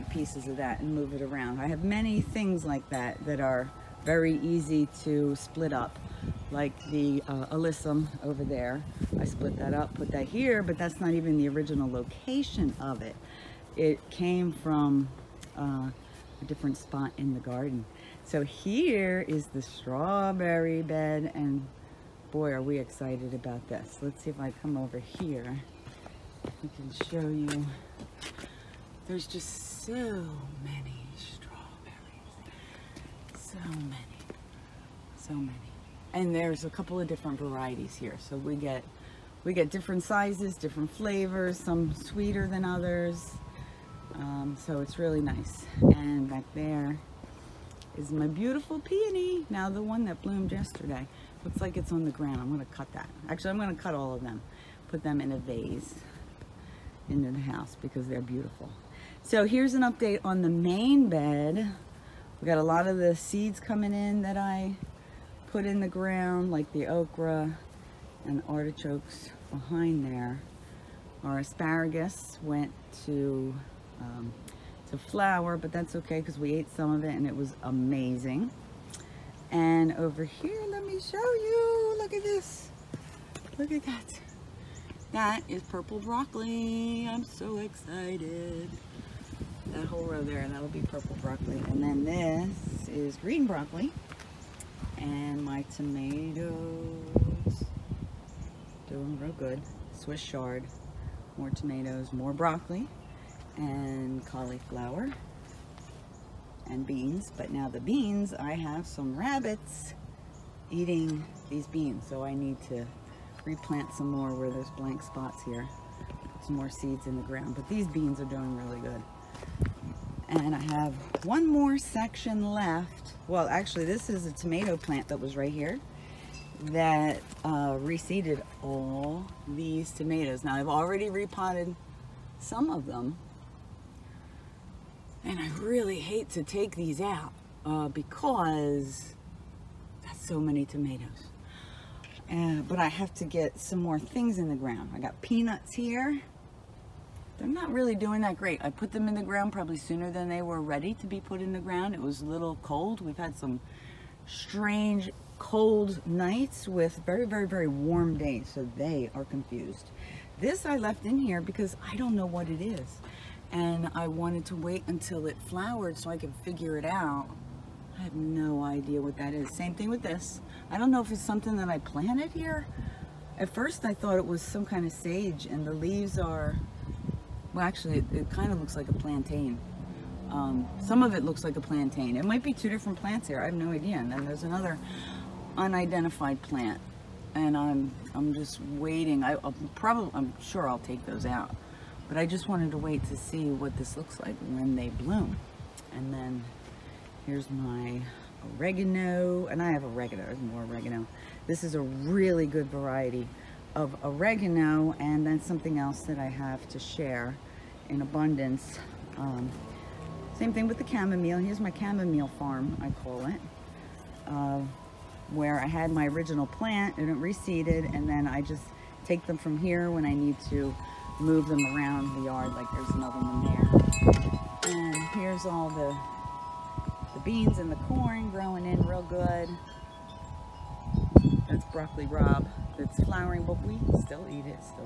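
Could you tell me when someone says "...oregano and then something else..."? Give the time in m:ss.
3:24.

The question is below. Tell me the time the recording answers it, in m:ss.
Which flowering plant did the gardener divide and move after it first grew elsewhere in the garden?
0:07.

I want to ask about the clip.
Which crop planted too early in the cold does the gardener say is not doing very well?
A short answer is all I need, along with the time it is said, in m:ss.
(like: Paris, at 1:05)
Peanuts, at 2:25.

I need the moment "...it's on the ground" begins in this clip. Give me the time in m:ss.
0:51.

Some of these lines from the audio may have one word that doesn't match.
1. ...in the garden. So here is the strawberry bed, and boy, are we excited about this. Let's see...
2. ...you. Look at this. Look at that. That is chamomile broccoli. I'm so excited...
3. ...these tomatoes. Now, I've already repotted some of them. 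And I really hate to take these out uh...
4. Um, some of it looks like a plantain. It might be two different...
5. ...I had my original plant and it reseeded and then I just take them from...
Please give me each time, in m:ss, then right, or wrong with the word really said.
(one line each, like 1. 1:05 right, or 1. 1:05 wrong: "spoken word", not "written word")
1. 0:17 right
2. 1:21 wrong: "purple", not "chamomile"
3. 2:09 right
4. 3:00 right
5. 3:35 right.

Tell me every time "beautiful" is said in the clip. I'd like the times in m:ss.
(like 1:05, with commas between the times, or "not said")
0:48, 0:58.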